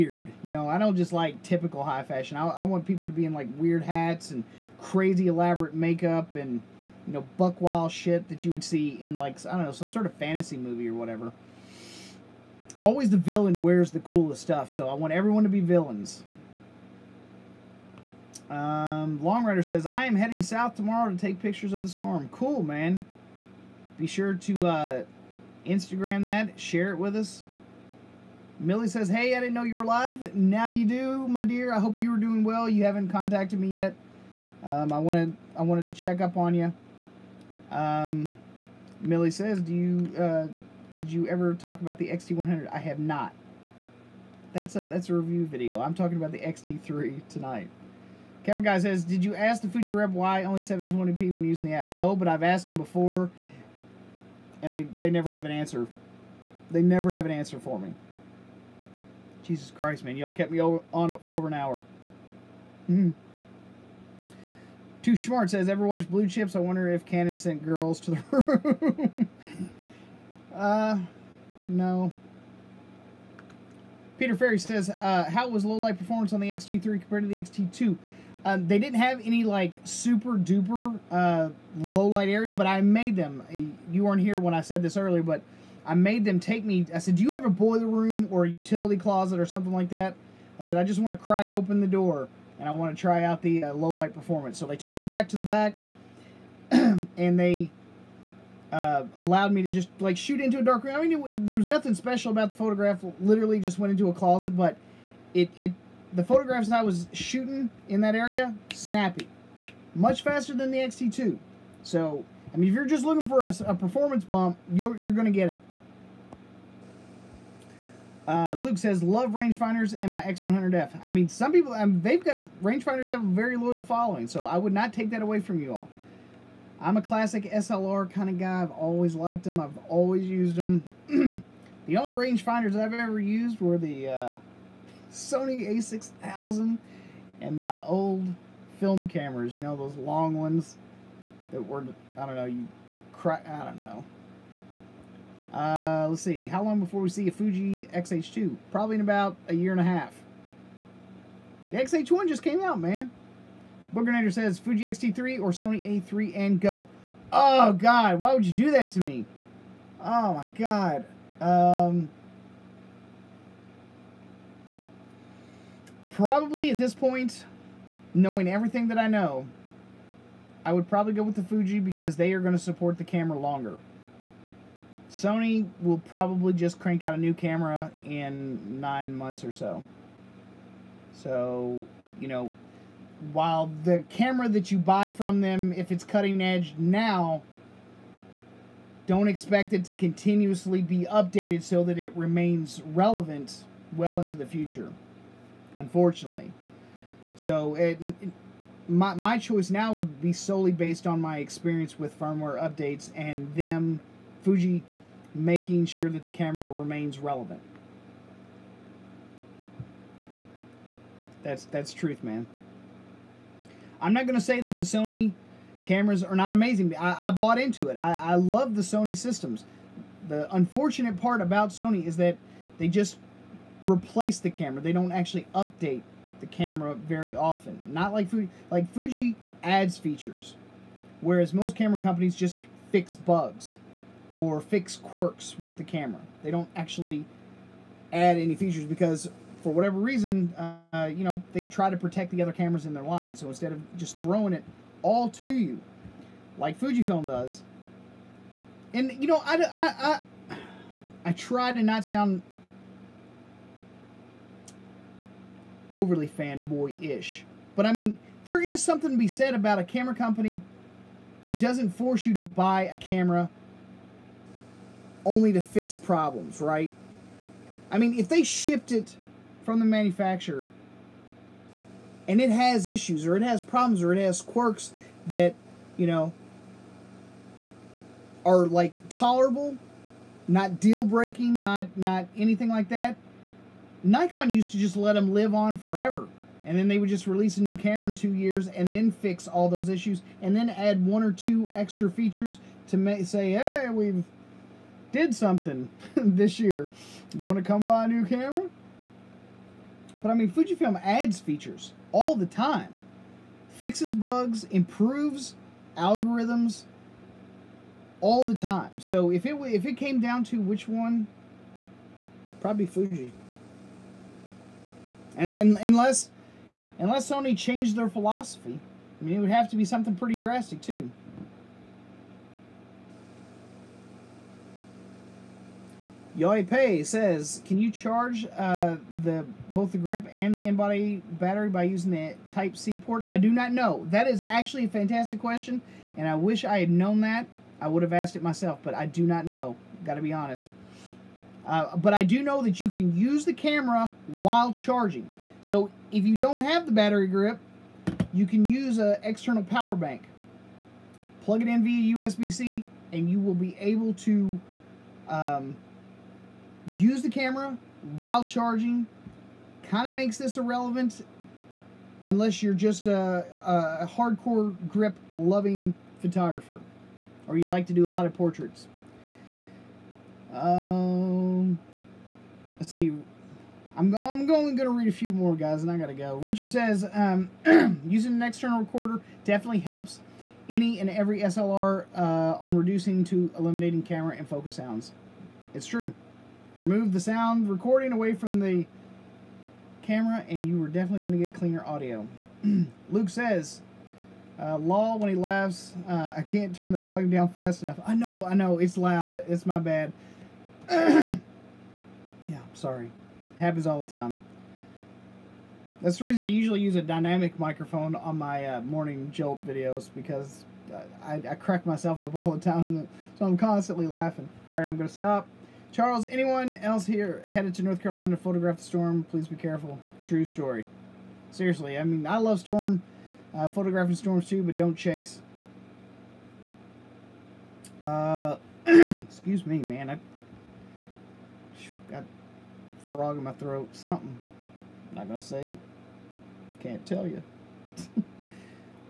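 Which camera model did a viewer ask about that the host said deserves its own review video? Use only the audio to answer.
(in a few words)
XT100.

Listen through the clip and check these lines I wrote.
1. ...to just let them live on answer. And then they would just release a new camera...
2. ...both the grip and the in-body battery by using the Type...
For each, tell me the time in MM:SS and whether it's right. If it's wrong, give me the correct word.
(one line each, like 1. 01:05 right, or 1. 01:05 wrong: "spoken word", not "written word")
1. 04:44 wrong: "forever", not "answer"
2. 05:29 right.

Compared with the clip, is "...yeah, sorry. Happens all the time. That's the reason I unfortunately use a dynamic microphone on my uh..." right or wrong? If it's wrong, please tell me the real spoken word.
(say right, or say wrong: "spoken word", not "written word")
wrong: "usually", not "unfortunately".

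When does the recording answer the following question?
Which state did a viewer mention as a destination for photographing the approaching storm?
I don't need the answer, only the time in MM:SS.
06:57.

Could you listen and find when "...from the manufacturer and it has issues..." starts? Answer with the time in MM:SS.
04:29.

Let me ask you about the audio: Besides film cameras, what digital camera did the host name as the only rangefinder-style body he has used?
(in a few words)
Sony a6000.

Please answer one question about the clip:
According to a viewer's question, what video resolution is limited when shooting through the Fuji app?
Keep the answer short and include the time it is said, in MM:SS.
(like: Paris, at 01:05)
720p, at 00:50.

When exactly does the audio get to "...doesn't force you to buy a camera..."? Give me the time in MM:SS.
04:21.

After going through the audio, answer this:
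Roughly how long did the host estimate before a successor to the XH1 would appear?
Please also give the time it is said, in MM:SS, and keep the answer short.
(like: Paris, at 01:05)
a year and a half, at 02:29.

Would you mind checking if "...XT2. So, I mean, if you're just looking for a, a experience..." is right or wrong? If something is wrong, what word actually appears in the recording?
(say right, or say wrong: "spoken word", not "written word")
wrong: "performance", not "experience".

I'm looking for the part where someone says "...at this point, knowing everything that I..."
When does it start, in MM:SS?
02:46.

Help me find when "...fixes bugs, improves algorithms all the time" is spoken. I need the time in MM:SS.
05:03.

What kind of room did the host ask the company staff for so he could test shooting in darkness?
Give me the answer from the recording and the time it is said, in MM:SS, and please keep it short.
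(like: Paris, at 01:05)
boiler room, at 01:27.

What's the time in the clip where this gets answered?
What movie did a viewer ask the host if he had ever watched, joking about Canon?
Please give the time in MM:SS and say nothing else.
01:06.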